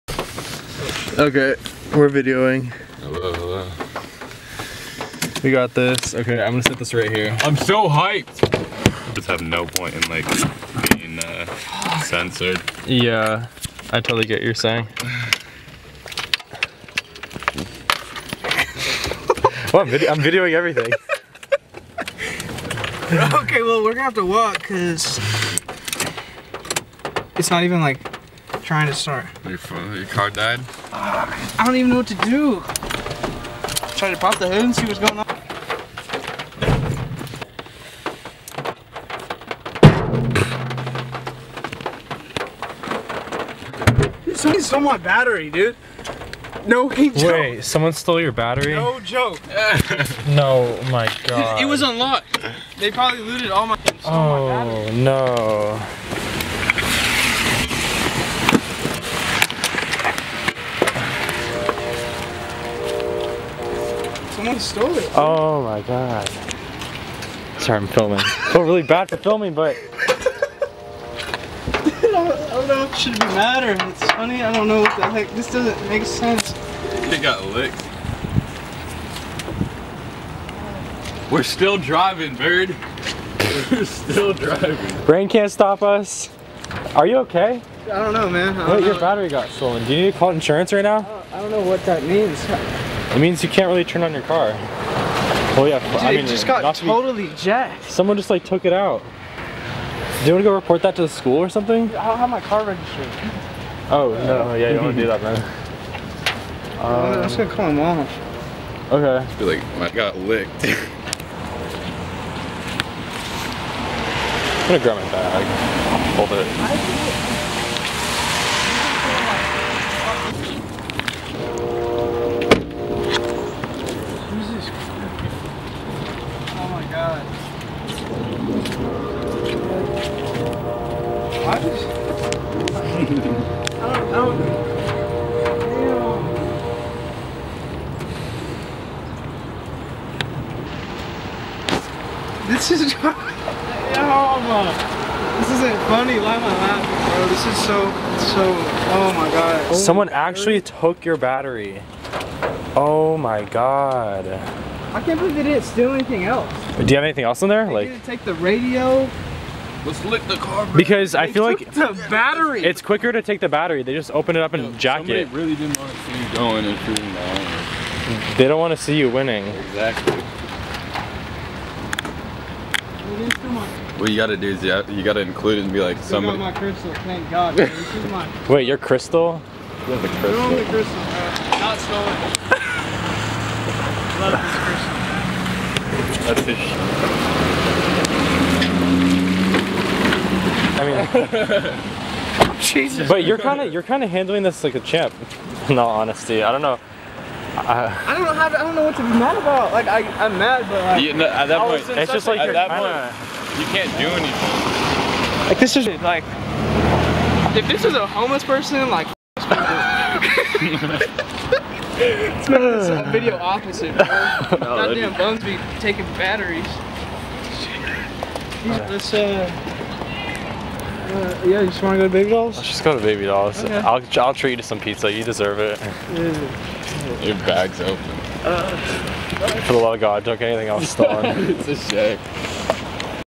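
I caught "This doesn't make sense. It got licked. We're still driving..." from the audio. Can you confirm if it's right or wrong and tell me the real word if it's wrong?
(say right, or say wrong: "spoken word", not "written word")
right.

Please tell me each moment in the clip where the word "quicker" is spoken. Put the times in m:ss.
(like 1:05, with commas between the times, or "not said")
2:42.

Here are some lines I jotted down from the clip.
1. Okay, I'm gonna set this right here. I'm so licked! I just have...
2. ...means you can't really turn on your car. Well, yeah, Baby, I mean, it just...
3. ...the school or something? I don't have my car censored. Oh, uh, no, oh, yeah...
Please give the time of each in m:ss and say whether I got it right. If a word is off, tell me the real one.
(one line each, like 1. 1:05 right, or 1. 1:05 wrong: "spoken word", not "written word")
1. 0:06 wrong: "hyped", not "licked"
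2. 1:33 wrong: "Dude", not "Baby"
3. 1:41 wrong: "registered", not "censored".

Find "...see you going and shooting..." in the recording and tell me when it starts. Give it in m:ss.
2:45.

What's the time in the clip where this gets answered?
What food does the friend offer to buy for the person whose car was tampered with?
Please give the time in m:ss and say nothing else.
3:44.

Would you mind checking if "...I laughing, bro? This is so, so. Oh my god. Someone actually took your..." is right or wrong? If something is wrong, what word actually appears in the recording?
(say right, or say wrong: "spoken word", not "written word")
right.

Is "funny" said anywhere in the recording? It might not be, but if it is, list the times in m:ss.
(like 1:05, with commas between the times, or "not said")
1:14, 2:25.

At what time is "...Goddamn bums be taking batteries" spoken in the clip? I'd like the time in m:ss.
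3:34.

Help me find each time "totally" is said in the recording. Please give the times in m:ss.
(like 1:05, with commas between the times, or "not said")
0:14, 1:36.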